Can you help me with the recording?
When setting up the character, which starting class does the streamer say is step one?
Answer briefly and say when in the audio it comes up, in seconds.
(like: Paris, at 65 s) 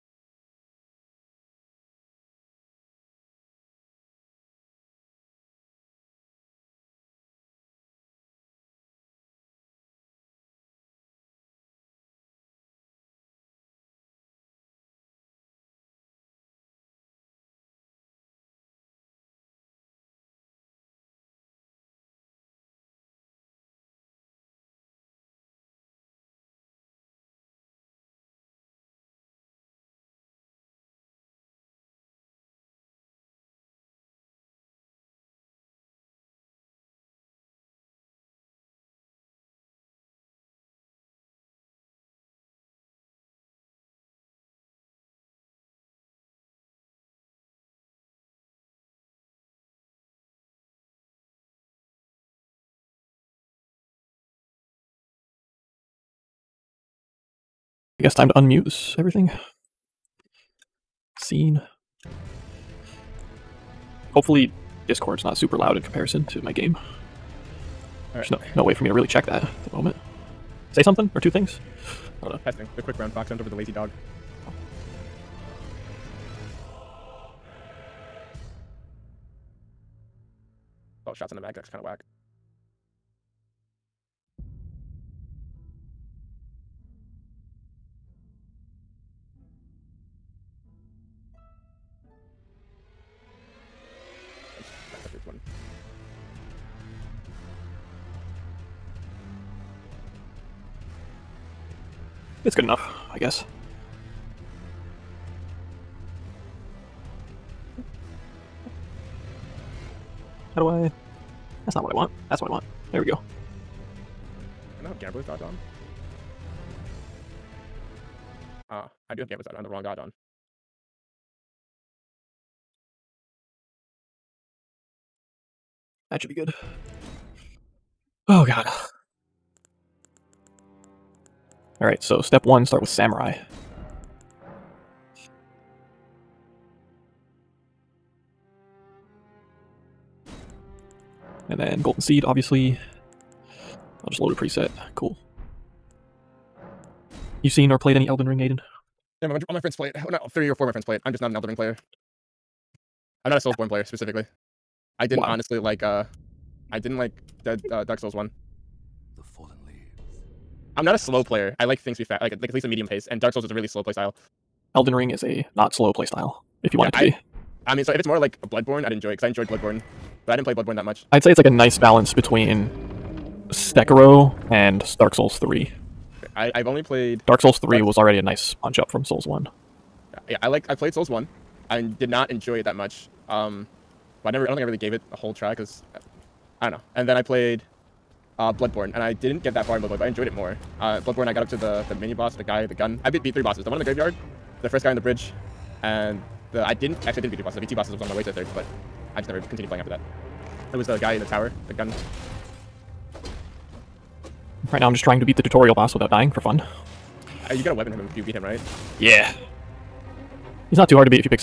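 Samurai, at 132 s.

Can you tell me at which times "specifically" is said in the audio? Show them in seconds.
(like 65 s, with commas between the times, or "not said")
153 s.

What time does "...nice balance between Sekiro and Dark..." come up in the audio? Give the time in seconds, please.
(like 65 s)
171 s.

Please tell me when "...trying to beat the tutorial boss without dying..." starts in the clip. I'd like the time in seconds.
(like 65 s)
205 s.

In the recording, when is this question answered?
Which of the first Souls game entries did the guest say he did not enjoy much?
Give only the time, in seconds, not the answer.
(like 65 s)
157 s.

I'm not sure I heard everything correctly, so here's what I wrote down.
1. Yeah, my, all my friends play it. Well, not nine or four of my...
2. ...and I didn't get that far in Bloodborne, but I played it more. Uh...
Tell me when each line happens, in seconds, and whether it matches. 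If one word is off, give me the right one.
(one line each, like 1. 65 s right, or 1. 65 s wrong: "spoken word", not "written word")
1. 149 s wrong: "three", not "nine"
2. 188 s wrong: "enjoyed", not "played".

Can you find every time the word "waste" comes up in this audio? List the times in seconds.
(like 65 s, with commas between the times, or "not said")
not said.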